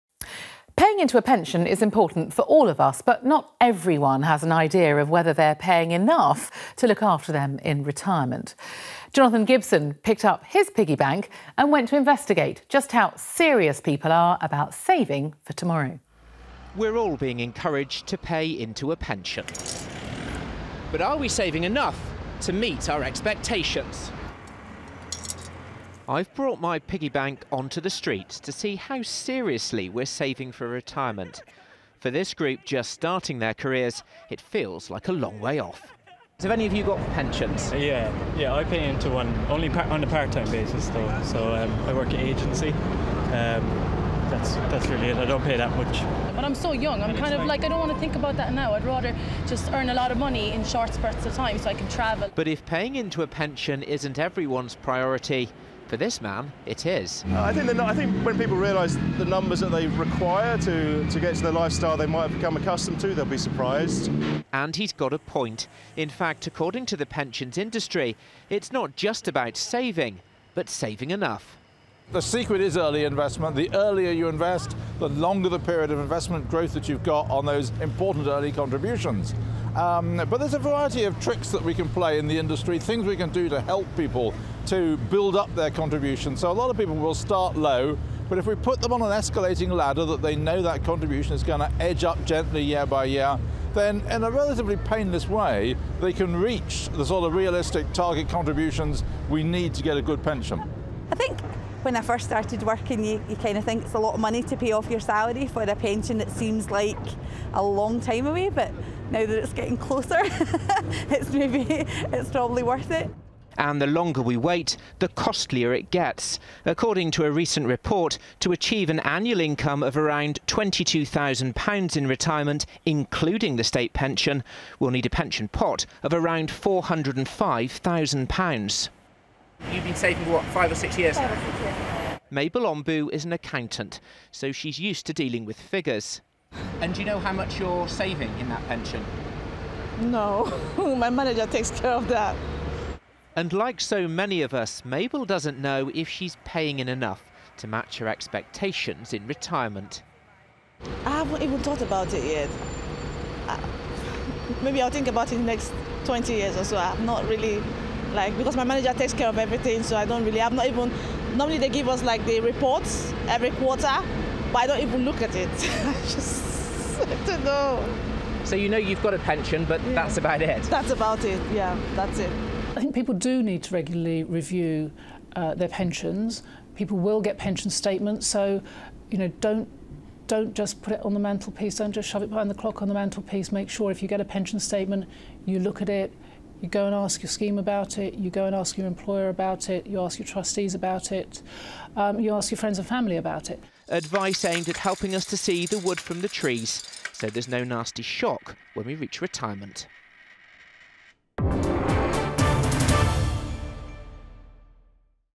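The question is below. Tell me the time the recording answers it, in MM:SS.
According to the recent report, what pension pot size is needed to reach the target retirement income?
02:06.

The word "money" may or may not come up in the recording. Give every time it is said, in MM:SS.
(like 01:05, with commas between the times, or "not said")
00:50, 01:44.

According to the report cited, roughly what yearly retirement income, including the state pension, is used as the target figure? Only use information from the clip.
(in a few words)
£22,000.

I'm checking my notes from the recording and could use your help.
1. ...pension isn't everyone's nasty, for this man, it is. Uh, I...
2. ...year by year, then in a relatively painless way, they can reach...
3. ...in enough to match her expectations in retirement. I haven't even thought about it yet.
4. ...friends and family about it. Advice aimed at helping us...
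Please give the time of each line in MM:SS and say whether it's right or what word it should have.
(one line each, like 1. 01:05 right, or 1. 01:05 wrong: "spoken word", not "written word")
1. 00:53 wrong: "priority", not "nasty"
2. 01:32 right
3. 02:26 right
4. 03:12 right.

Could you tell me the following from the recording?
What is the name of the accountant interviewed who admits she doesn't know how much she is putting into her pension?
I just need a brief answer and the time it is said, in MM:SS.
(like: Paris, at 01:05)
Mabel Ombu, at 02:12.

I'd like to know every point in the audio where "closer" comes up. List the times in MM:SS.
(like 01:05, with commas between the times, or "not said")
01:49.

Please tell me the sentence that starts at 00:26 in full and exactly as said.
I've brought my piggy bank onto the streets to see how seriously we're saving for retirement.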